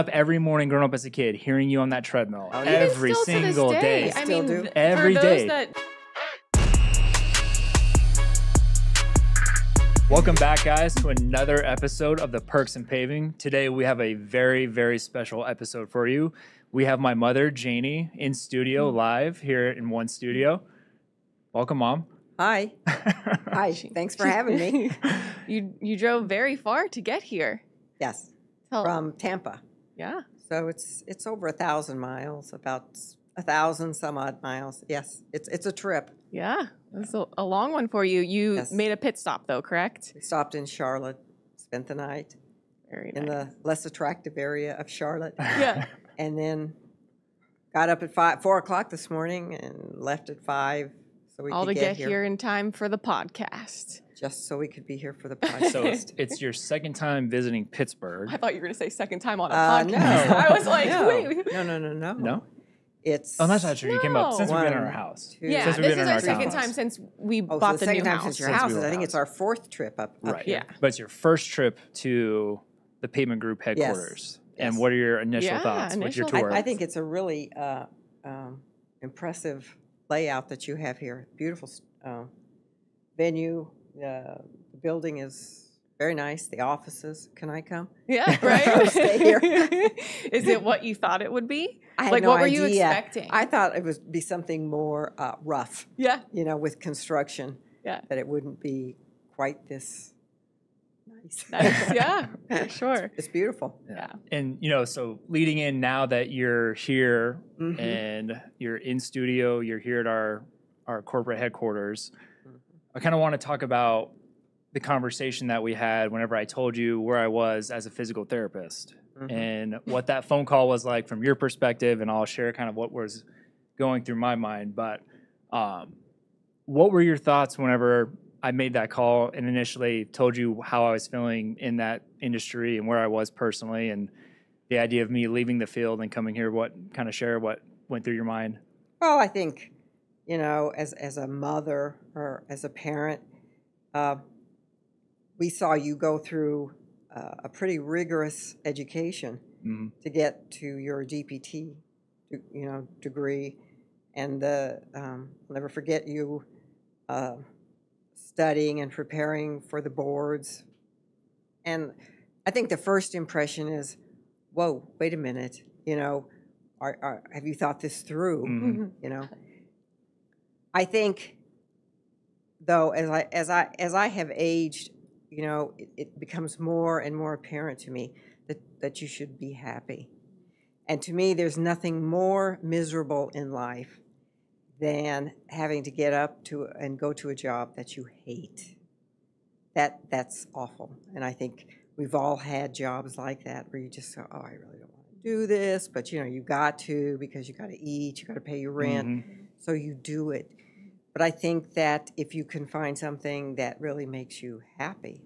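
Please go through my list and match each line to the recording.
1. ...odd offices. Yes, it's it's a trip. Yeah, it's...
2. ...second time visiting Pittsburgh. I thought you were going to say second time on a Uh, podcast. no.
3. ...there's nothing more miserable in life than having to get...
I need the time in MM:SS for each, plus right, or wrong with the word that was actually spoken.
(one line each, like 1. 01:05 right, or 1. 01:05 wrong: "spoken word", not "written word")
1. 00:34 wrong: "miles", not "offices"
2. 00:56 right
3. 03:01 right.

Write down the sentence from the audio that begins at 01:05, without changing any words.
Two, yeah, since we've this been is in our, our second house.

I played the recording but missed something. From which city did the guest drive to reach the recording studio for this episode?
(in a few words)
Tampa.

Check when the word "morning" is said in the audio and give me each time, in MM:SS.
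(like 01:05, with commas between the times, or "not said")
00:00, 00:49.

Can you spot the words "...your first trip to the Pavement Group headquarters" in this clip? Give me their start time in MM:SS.
01:10.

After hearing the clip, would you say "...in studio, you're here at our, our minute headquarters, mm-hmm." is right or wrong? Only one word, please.
wrong.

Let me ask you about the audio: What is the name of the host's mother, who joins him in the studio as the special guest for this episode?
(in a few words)
Jani.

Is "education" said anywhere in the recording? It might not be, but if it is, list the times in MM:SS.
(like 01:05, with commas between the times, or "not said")
02:28.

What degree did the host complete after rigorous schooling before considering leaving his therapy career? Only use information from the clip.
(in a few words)
DPT.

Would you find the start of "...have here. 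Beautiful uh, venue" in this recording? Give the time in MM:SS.
01:20.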